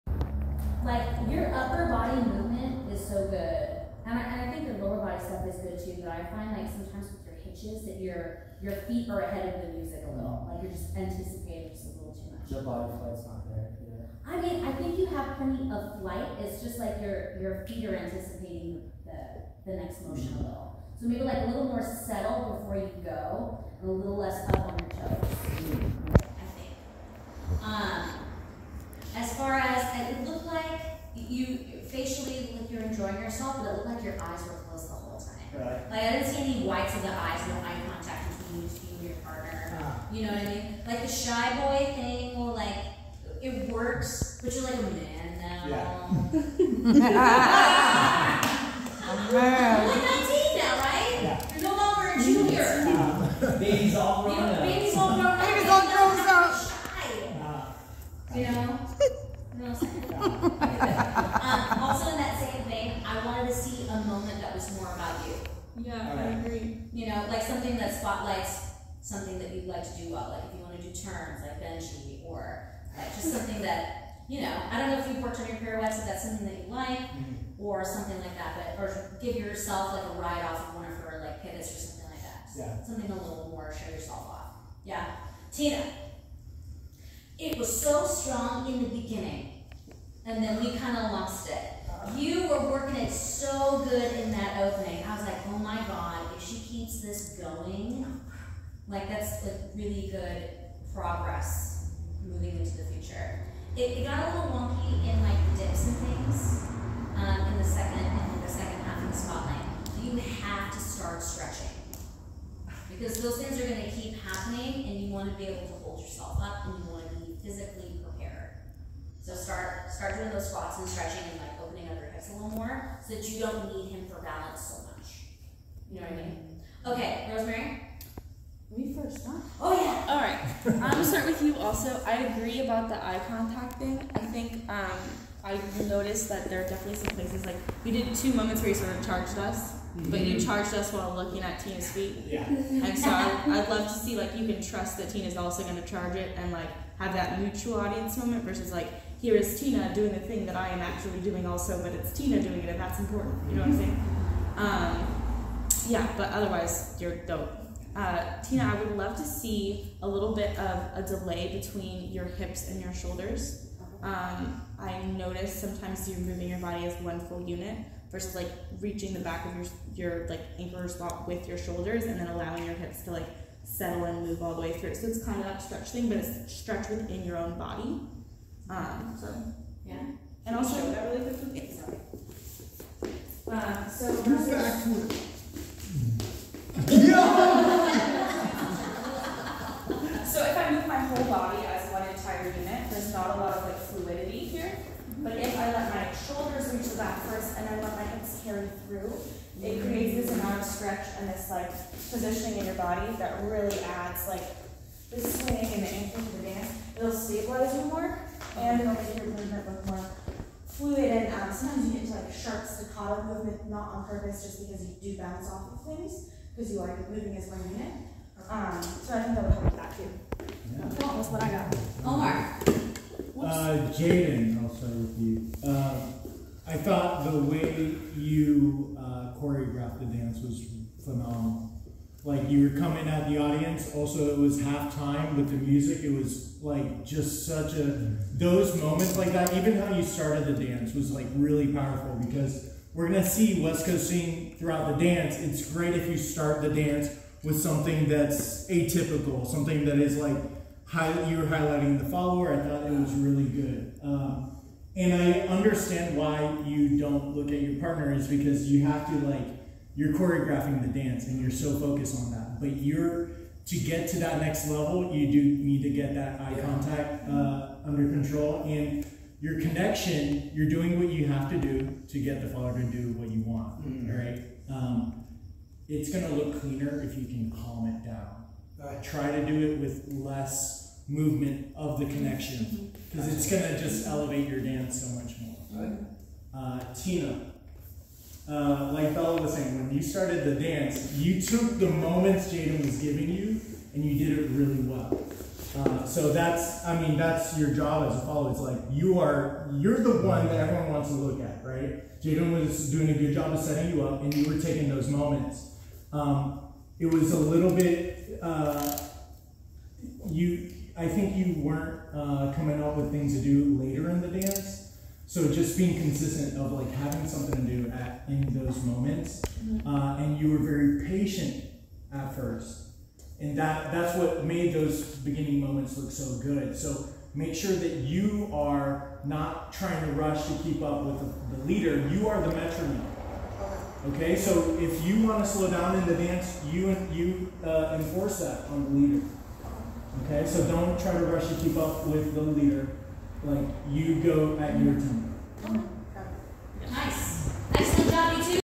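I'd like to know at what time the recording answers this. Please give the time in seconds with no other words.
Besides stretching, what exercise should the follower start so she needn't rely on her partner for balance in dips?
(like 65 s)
120 s.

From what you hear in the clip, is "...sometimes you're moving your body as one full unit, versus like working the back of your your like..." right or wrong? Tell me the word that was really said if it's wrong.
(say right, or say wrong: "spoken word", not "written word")
wrong: "reaching", not "working".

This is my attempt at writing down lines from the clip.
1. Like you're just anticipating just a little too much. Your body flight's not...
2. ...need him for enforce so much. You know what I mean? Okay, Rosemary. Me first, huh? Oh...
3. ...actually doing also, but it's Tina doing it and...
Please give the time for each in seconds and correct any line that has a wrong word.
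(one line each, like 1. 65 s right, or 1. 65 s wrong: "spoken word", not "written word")
1. 10 s right
2. 123 s wrong: "balance", not "enforce"
3. 150 s right.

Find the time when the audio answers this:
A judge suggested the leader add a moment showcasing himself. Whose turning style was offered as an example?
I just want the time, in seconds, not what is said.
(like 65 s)
71 s.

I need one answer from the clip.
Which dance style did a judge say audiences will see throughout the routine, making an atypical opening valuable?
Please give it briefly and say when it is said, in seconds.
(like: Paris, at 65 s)
West Coast swing, at 243 s.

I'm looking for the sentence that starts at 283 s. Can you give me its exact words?
because it's going to just elevate your dance so much more.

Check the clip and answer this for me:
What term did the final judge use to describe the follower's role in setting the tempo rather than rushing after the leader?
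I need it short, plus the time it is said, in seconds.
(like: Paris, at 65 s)
Metronome, at 332 s.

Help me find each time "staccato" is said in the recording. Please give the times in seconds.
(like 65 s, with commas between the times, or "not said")
212 s.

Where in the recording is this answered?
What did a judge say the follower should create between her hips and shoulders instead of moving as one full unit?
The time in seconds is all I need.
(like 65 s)
160 s.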